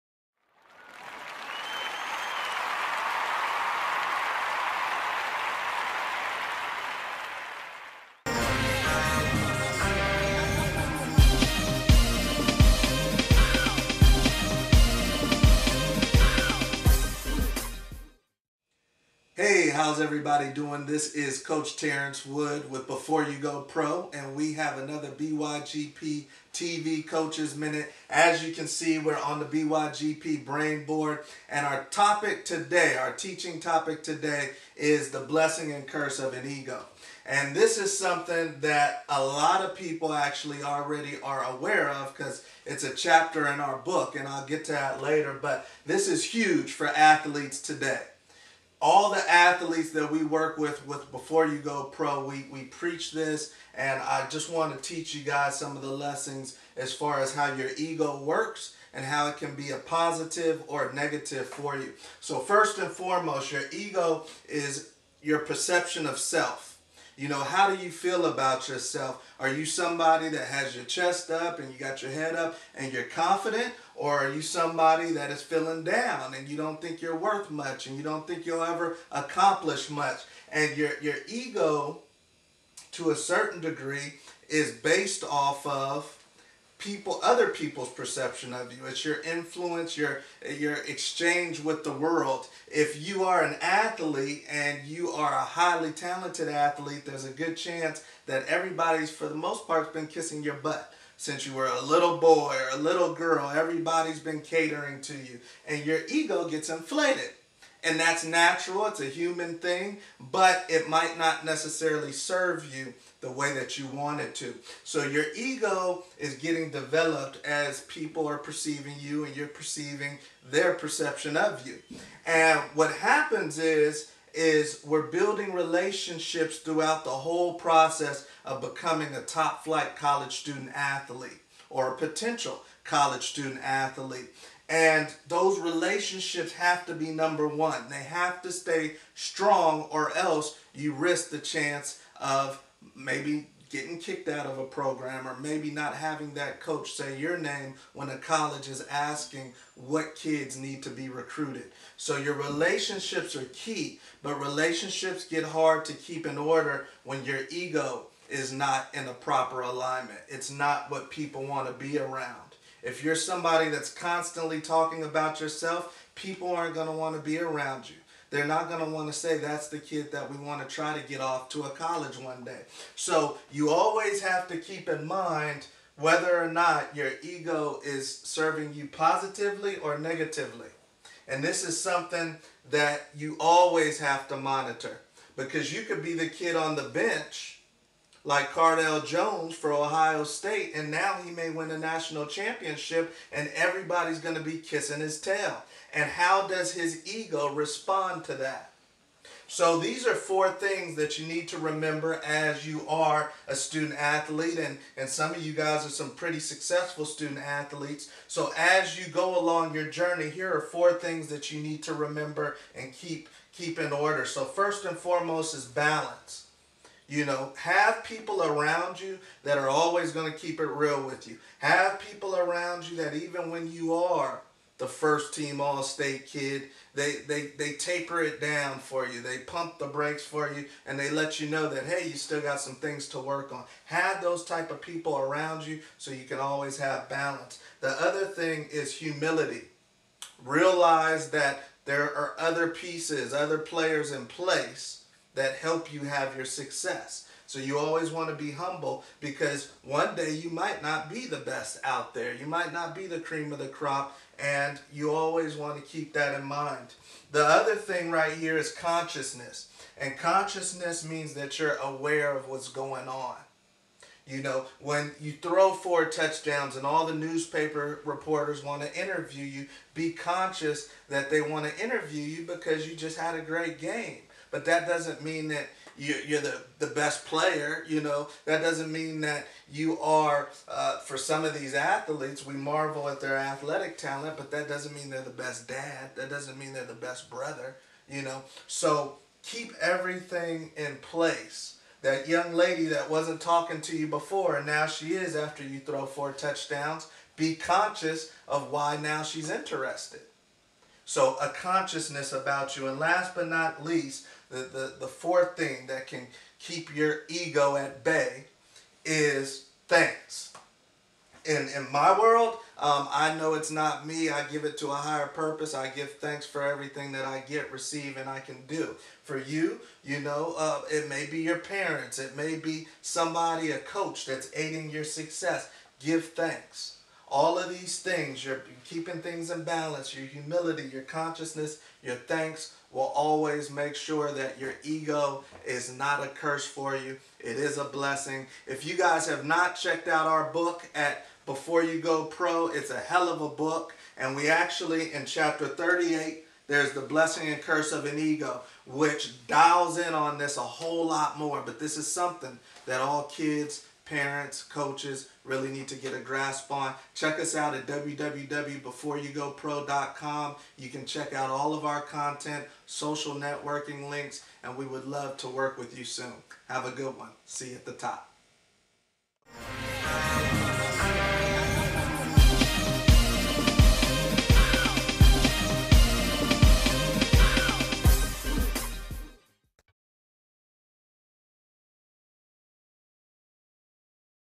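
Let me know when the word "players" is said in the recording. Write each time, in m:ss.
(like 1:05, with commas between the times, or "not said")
4:03, 4:37.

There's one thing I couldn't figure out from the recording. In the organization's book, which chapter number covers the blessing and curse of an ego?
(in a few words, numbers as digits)
38.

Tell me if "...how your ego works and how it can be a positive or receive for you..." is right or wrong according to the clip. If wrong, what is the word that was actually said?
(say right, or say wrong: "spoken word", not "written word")
wrong: "negative", not "receive".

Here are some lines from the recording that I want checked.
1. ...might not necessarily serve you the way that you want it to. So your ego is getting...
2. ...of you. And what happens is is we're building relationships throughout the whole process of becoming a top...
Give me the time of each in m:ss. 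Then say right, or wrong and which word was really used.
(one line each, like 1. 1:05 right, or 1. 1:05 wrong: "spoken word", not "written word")
1. 1:50 right
2. 2:01 right.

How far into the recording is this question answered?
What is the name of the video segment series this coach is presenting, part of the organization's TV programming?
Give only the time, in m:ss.
0:27.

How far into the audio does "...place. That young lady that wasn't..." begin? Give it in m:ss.
4:51.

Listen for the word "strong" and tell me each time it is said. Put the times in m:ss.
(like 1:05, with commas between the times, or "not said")
2:19.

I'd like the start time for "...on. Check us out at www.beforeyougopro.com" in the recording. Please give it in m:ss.
5:56.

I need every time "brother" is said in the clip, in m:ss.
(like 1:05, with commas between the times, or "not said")
4:47.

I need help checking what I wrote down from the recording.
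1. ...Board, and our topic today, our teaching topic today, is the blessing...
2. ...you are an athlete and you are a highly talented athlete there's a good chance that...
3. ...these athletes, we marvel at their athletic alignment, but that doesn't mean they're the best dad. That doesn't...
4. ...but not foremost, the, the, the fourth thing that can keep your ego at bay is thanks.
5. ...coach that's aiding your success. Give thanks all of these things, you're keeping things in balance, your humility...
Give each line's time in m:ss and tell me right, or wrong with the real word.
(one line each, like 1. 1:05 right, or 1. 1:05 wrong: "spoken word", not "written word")
1. 0:30 right
2. 1:33 right
3. 4:41 wrong: "talent", not "alignment"
4. 5:03 wrong: "least", not "foremost"
5. 5:23 right.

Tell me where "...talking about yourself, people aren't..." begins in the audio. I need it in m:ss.
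2:44.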